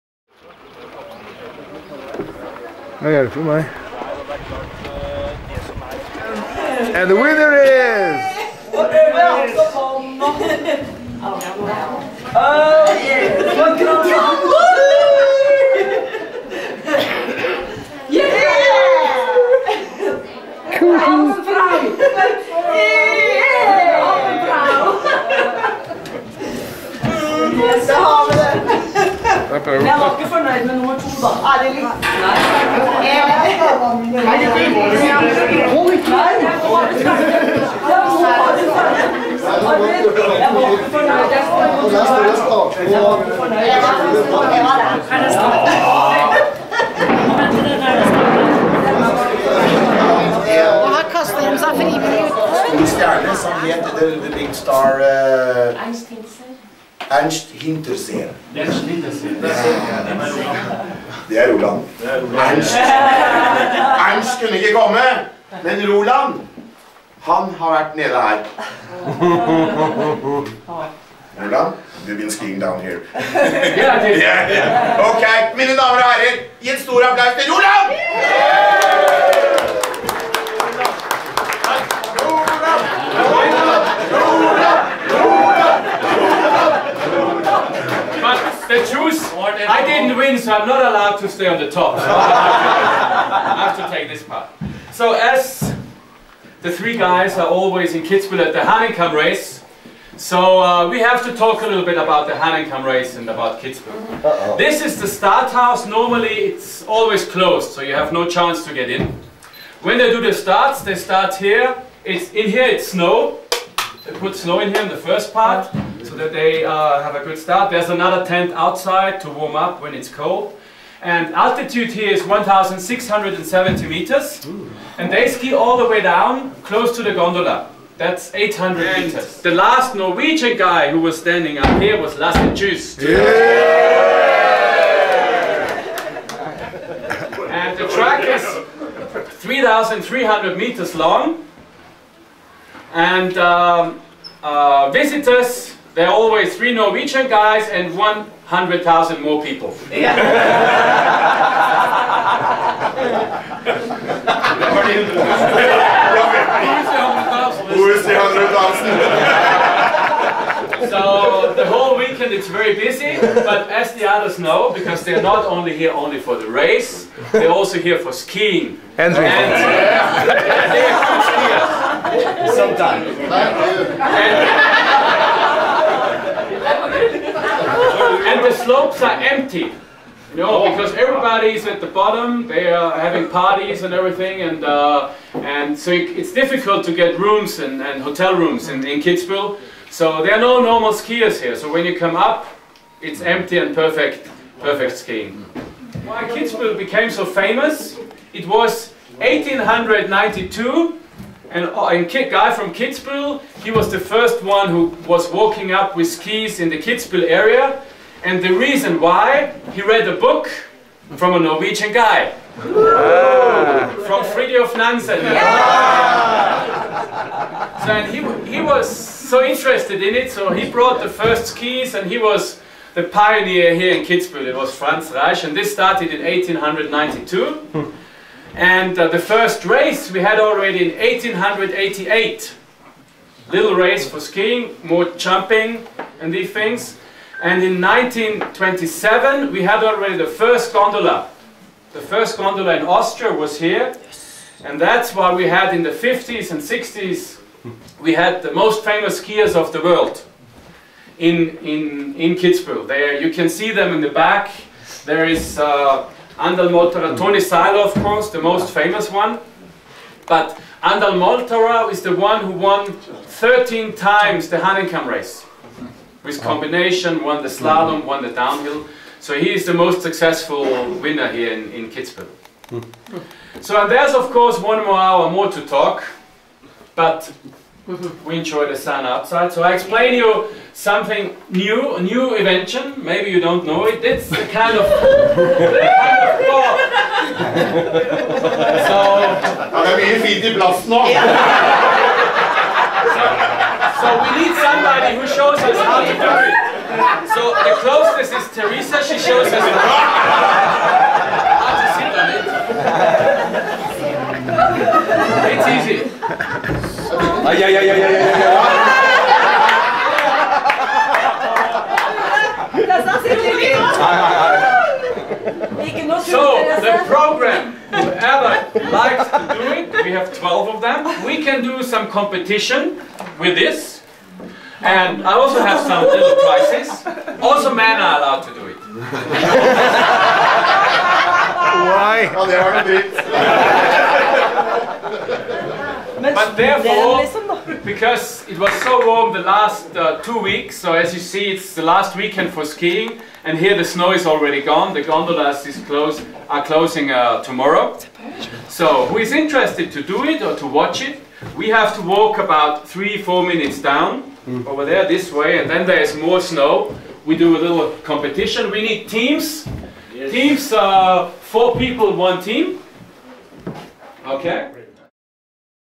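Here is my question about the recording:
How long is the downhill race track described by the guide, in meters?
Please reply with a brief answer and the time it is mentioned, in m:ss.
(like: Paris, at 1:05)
3,300 meters, at 2:19.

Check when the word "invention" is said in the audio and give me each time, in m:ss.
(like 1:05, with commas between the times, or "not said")
4:42.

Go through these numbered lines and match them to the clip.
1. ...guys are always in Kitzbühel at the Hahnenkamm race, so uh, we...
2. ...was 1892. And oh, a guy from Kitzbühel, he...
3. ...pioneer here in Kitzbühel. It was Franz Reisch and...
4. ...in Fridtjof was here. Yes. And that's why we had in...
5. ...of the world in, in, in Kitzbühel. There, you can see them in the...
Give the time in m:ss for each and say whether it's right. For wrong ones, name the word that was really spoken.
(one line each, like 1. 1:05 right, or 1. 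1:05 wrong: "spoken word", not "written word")
1. 1:36 right
2. 3:18 right
3. 3:43 right
4. 4:02 wrong: "Austria", not "Fridtjof"
5. 4:09 right.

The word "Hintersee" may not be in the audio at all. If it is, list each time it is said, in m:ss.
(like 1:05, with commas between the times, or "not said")
0:57.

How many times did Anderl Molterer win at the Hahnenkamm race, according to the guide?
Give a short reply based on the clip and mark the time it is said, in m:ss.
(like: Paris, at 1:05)
13, at 4:22.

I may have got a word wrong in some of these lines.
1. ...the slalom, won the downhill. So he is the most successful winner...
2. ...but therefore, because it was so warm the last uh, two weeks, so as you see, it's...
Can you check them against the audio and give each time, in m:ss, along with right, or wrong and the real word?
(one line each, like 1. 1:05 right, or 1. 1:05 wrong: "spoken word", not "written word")
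1. 4:27 right
2. 5:36 right.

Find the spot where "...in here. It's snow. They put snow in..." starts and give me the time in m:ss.
1:52.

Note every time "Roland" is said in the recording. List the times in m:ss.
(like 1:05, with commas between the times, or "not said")
1:01, 1:05, 1:11, 1:17.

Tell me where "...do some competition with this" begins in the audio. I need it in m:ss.
5:21.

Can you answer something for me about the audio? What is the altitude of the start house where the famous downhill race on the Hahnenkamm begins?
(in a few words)
1,670 meters.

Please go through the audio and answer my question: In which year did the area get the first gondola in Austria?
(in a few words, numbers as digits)
1927.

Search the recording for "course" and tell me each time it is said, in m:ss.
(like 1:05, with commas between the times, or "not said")
4:18, 4:34.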